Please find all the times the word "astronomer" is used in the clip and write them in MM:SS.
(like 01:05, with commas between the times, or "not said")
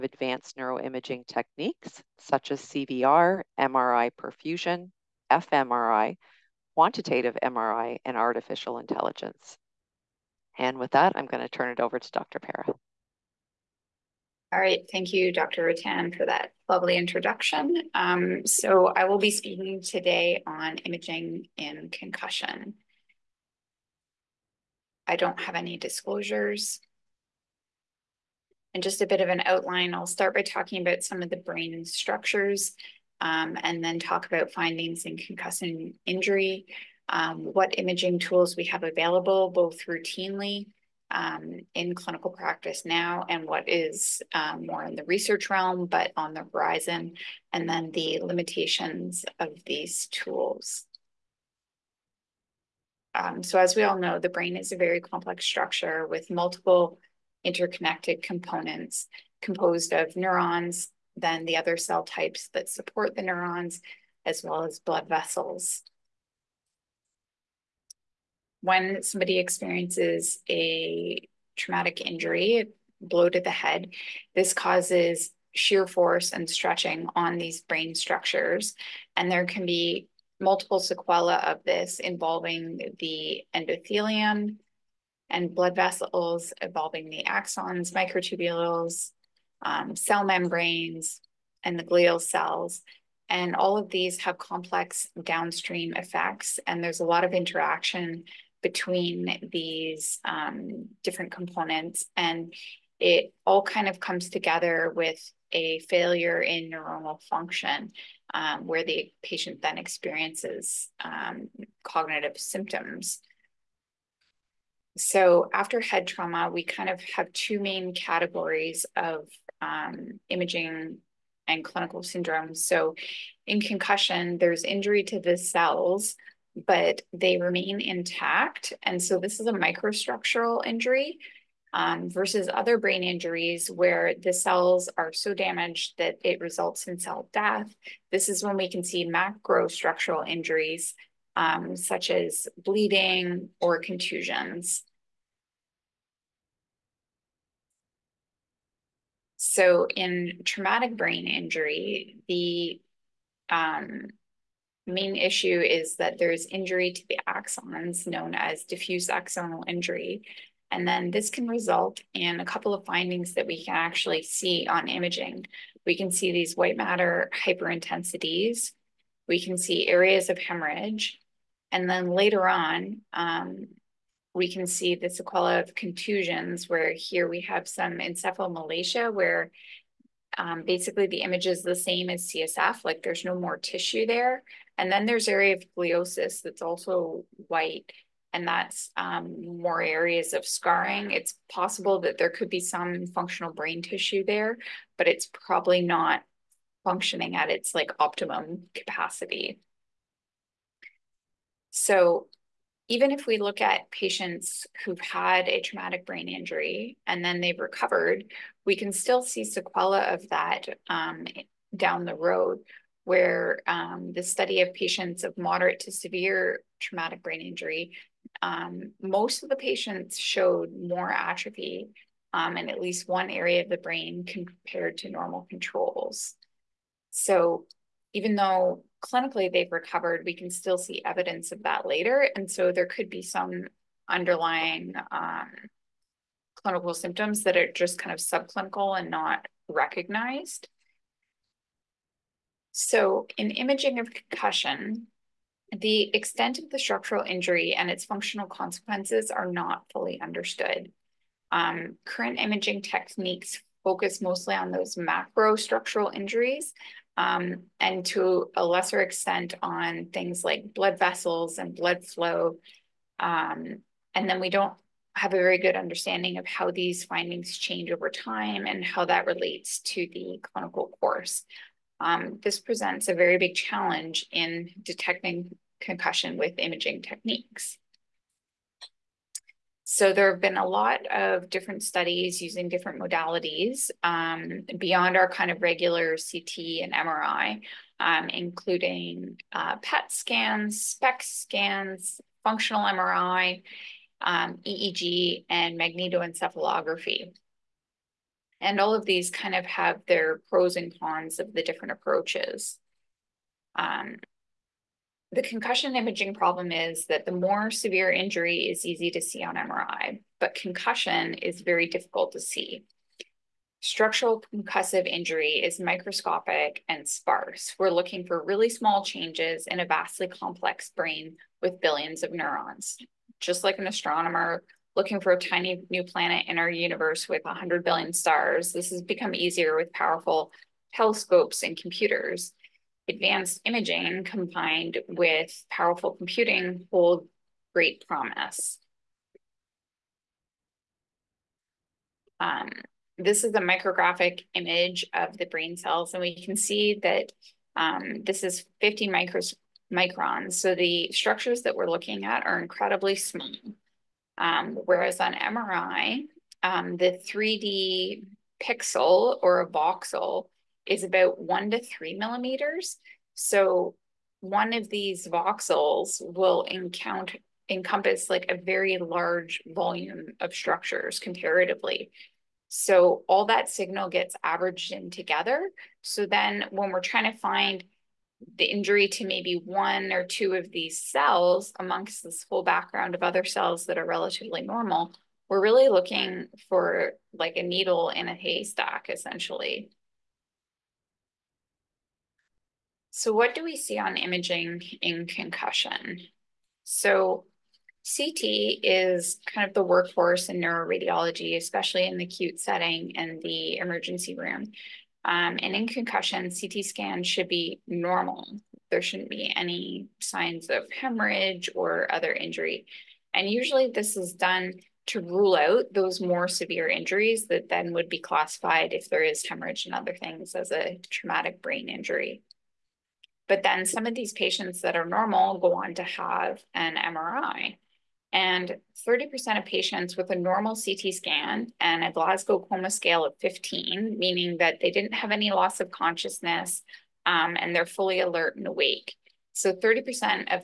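05:23.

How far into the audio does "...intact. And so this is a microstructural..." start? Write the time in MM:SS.
02:07.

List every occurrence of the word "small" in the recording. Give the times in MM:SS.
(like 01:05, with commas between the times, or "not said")
05:18, 05:53.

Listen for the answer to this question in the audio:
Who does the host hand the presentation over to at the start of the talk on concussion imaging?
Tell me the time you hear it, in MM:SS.
00:12.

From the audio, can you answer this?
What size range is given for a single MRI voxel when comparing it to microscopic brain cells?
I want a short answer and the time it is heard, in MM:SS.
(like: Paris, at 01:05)
1 to 3 millimeters, at 06:01.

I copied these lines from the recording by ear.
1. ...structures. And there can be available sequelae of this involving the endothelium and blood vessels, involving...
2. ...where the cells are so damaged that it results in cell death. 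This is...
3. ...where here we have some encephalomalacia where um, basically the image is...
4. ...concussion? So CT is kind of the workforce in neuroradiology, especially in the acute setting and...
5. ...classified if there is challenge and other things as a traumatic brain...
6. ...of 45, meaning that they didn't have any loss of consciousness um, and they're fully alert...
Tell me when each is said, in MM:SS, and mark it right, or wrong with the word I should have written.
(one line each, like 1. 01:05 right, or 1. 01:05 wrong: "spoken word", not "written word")
1. 01:17 wrong: "multiple", not "available"
2. 02:13 right
3. 02:56 right
4. 06:35 right
5. 06:58 wrong: "hemorrhage", not "challenge"
6. 07:13 wrong: "15", not "45".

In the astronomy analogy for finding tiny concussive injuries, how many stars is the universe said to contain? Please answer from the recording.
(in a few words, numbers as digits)
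100 billion.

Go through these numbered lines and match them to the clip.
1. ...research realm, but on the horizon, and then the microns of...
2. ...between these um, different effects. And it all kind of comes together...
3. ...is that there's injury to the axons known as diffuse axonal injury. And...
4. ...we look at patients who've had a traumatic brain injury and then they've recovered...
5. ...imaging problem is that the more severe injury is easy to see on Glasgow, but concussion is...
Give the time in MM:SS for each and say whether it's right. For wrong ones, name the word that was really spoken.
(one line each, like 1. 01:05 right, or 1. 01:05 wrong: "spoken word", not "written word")
1. 00:45 wrong: "limitations", not "microns"
2. 01:38 wrong: "components", not "effects"
3. 02:35 right
4. 03:23 right
5. 05:05 wrong: "MRI", not "Glasgow".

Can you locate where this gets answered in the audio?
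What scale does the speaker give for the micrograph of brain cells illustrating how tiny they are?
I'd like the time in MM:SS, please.
05:48.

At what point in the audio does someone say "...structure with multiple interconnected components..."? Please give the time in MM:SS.
00:55.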